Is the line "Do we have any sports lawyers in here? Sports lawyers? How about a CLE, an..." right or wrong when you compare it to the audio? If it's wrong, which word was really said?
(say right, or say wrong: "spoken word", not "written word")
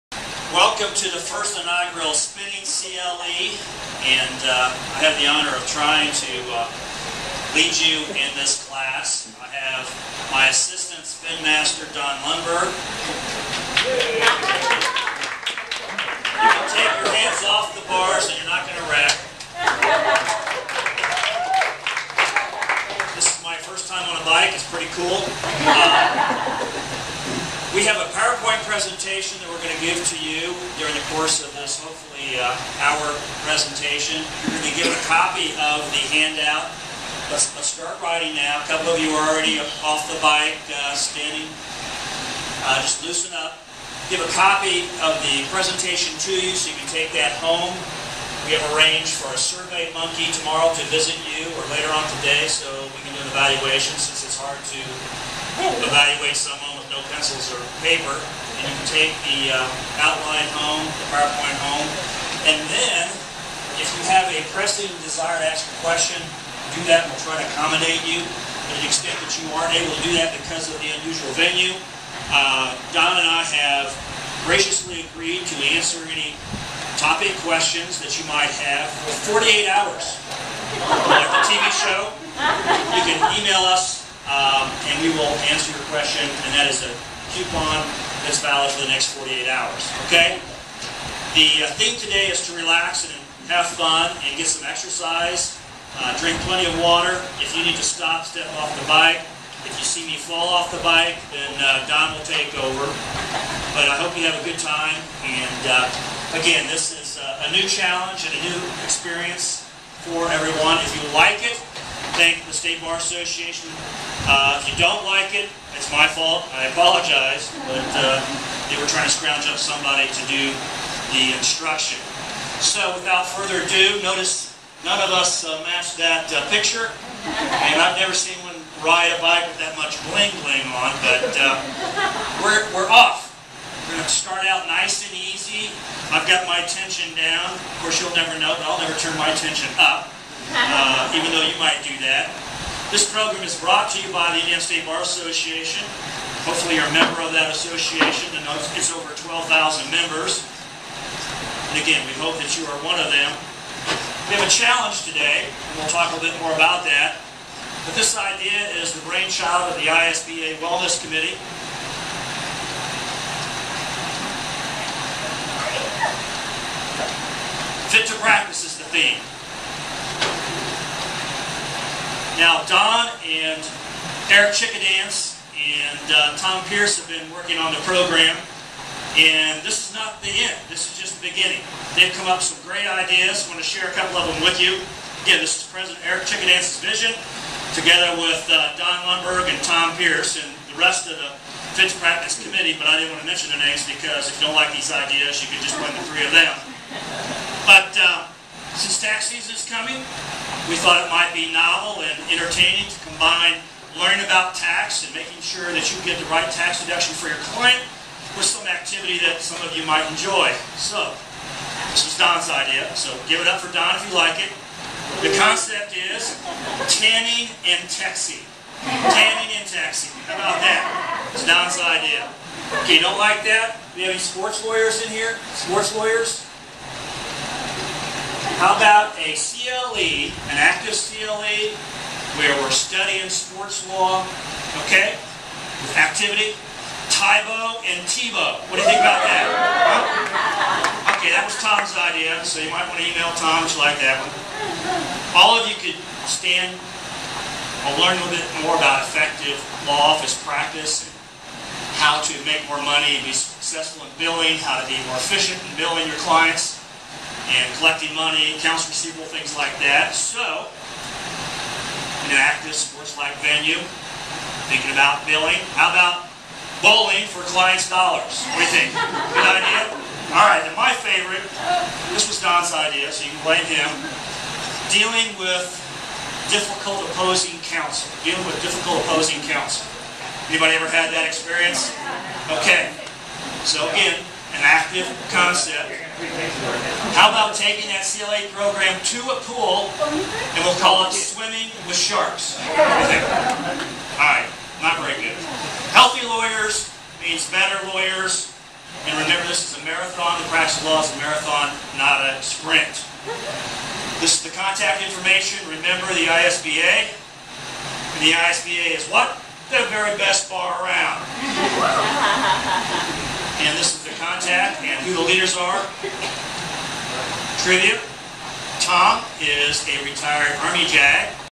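right.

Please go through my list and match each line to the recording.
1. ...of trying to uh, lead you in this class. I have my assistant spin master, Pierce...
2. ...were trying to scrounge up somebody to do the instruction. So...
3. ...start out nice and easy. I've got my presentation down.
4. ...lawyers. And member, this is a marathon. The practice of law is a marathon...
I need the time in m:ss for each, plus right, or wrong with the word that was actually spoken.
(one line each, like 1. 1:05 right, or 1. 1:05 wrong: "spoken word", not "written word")
1. 0:05 wrong: "Don", not "Pierce"
2. 1:58 right
3. 2:14 wrong: "tension", not "presentation"
4. 4:57 wrong: "remember", not "member".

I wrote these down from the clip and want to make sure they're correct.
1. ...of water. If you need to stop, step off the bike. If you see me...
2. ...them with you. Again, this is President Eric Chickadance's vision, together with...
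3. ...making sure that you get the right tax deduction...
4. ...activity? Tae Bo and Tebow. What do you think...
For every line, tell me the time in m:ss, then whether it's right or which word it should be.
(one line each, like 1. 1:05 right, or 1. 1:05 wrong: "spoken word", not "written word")
1. 1:36 right
2. 3:04 right
3. 3:25 right
4. 3:55 right.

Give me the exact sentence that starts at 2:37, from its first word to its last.
But this idea is the brainchild of the ISBA Wellness Committee.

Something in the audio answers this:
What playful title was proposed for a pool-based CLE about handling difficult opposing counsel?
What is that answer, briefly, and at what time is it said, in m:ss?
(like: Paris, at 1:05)
Swimming with sharks, at 4:51.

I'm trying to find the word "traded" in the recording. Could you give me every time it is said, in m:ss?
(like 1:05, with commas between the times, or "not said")
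not said.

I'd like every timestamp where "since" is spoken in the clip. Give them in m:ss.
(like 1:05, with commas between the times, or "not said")
0:53, 3:18.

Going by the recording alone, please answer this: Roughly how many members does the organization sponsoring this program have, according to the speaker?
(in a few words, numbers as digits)
over 12,000.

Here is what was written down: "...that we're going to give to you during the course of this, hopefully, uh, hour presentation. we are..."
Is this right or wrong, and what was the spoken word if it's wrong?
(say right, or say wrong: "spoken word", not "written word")
right.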